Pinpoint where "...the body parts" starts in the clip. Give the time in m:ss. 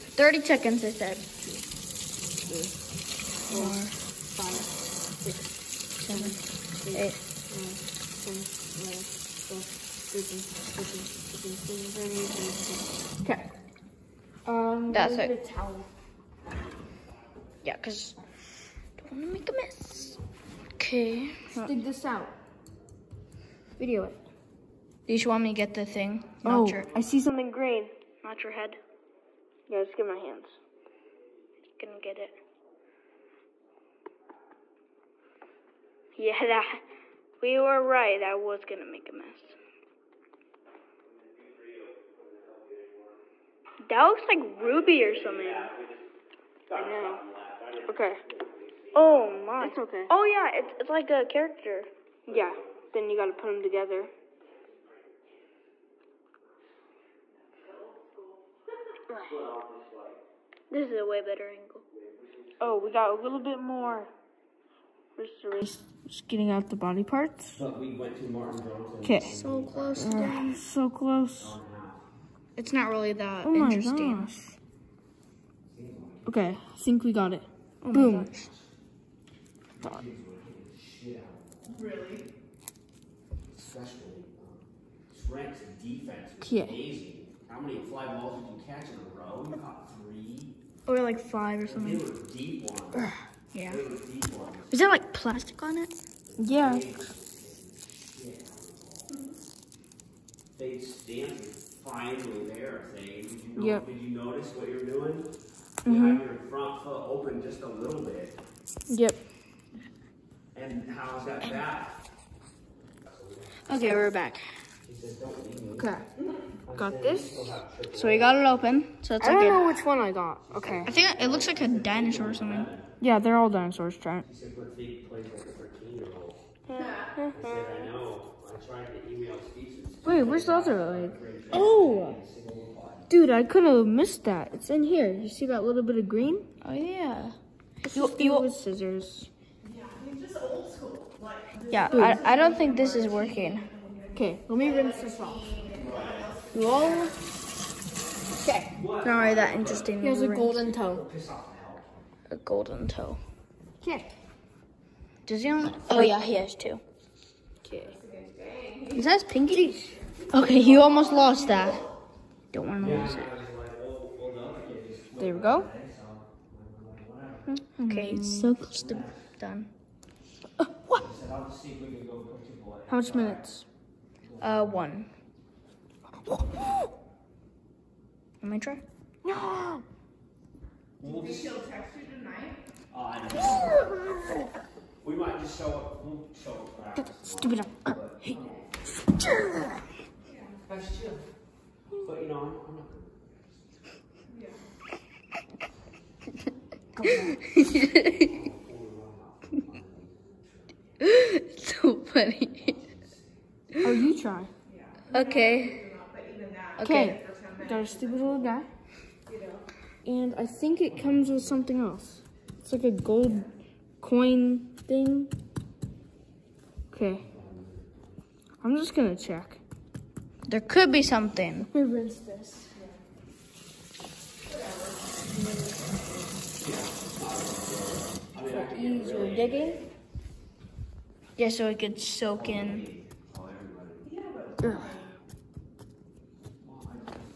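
1:06.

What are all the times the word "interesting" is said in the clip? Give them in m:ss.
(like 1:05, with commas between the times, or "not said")
1:13, 2:29.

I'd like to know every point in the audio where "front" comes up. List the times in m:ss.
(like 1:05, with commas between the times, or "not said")
1:46.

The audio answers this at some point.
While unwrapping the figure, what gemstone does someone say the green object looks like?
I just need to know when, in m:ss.
0:44.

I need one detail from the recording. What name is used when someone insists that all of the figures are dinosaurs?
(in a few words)
Trent.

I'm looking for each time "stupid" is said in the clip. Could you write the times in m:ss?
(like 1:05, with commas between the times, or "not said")
3:07, 3:27.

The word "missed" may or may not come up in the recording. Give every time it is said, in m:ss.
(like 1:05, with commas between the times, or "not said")
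2:13.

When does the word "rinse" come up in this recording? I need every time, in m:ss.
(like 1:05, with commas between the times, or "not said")
2:24, 3:41.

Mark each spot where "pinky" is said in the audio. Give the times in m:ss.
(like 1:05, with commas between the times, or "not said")
2:39.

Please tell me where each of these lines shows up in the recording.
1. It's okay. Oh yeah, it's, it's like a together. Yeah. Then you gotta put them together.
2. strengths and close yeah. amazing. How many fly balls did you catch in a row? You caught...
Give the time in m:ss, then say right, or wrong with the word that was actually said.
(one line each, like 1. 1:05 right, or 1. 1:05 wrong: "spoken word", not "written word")
1. 0:49 wrong: "character", not "together"
2. 1:25 wrong: "defense", not "close".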